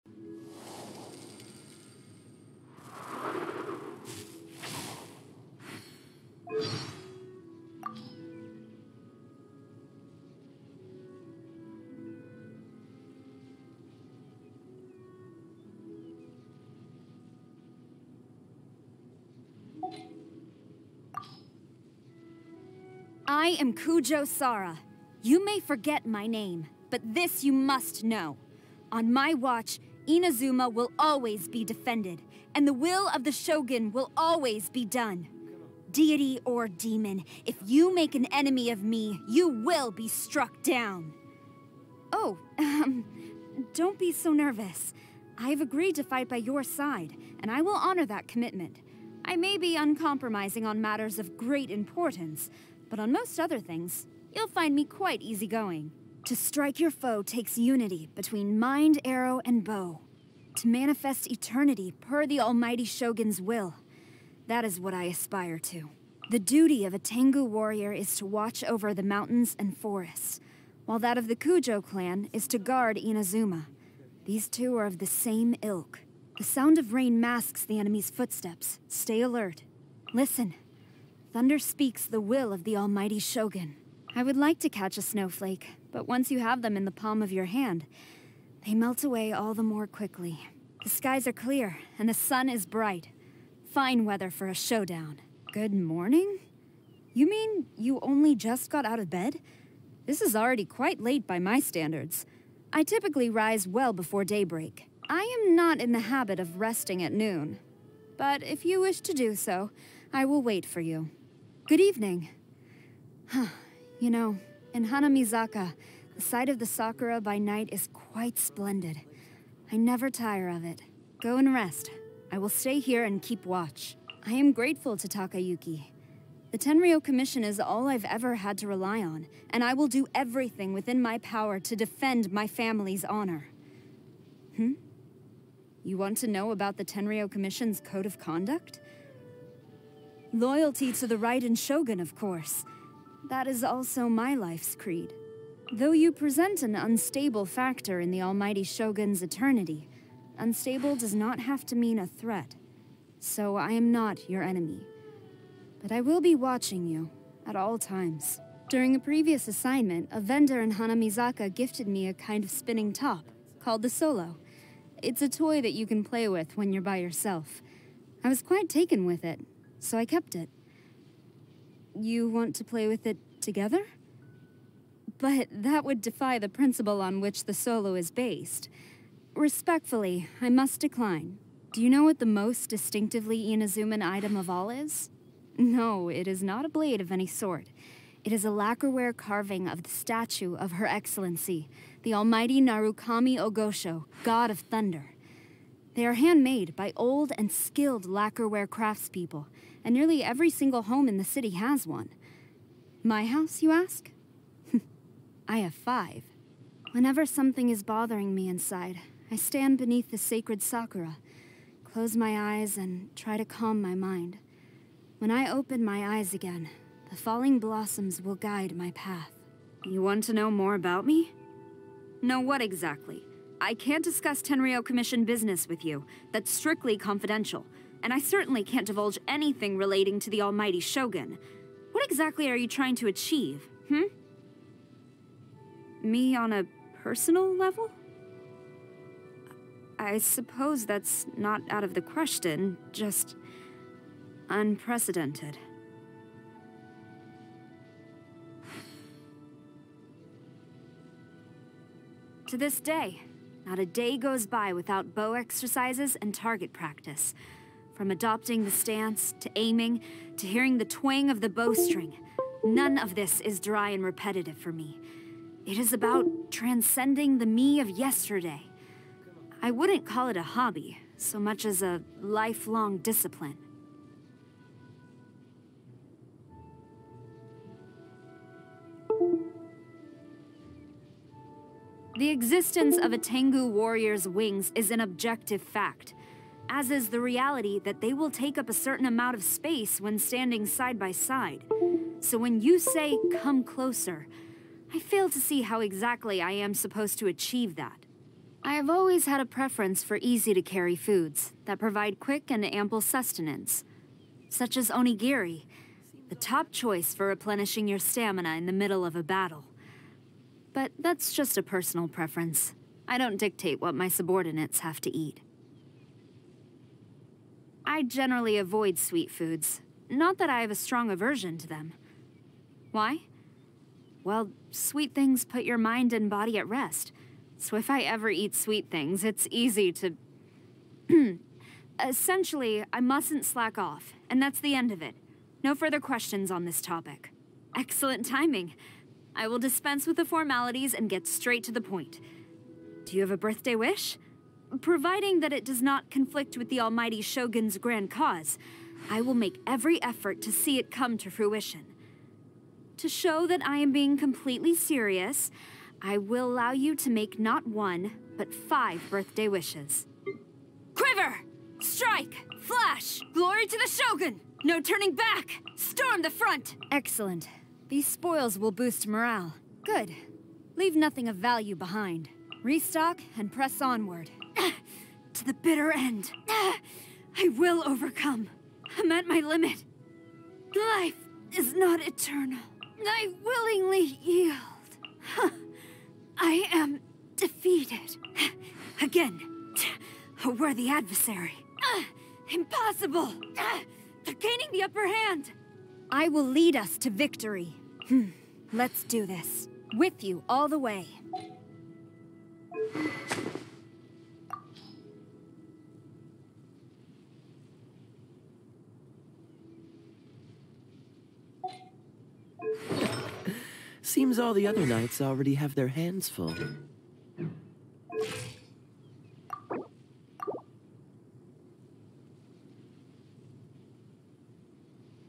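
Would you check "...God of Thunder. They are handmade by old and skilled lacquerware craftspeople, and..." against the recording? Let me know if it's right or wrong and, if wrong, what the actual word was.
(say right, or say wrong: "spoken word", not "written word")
right.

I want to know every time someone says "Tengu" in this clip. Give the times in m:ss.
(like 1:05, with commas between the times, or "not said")
1:06, 4:43.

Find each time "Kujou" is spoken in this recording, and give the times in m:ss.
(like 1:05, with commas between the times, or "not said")
0:23, 1:11.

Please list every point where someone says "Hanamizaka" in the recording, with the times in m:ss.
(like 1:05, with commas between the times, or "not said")
1:54, 2:40.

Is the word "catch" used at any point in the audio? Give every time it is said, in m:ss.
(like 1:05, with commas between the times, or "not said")
1:24.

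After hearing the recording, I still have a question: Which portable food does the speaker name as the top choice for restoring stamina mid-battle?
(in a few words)
Onigiri.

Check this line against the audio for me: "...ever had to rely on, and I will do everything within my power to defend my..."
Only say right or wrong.
right.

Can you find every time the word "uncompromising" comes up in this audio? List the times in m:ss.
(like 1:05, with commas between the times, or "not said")
0:49.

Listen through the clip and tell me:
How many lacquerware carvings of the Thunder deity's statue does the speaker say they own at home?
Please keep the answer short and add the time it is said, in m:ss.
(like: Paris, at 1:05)
5, at 3:25.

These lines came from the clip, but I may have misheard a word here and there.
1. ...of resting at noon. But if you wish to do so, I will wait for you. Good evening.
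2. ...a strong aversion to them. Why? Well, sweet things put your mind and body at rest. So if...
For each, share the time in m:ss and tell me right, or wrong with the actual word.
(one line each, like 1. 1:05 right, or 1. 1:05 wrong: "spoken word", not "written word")
1. 1:46 right
2. 5:20 right.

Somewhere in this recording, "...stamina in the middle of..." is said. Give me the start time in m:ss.
5:07.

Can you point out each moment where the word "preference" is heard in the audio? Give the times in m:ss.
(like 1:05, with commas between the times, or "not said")
4:59, 5:12.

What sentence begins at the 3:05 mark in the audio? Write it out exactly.
No, it is not a blade of any sort.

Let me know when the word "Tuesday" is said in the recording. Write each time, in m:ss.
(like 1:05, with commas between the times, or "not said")
not said.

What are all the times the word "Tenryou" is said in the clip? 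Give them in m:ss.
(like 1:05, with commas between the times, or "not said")
2:06, 2:16, 3:44.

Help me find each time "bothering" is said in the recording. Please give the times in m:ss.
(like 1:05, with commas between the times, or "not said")
3:27.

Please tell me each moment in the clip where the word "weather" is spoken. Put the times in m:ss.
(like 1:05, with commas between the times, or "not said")
1:34.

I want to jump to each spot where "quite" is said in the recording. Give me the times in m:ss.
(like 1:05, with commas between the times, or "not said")
0:54, 1:40, 1:57, 2:48.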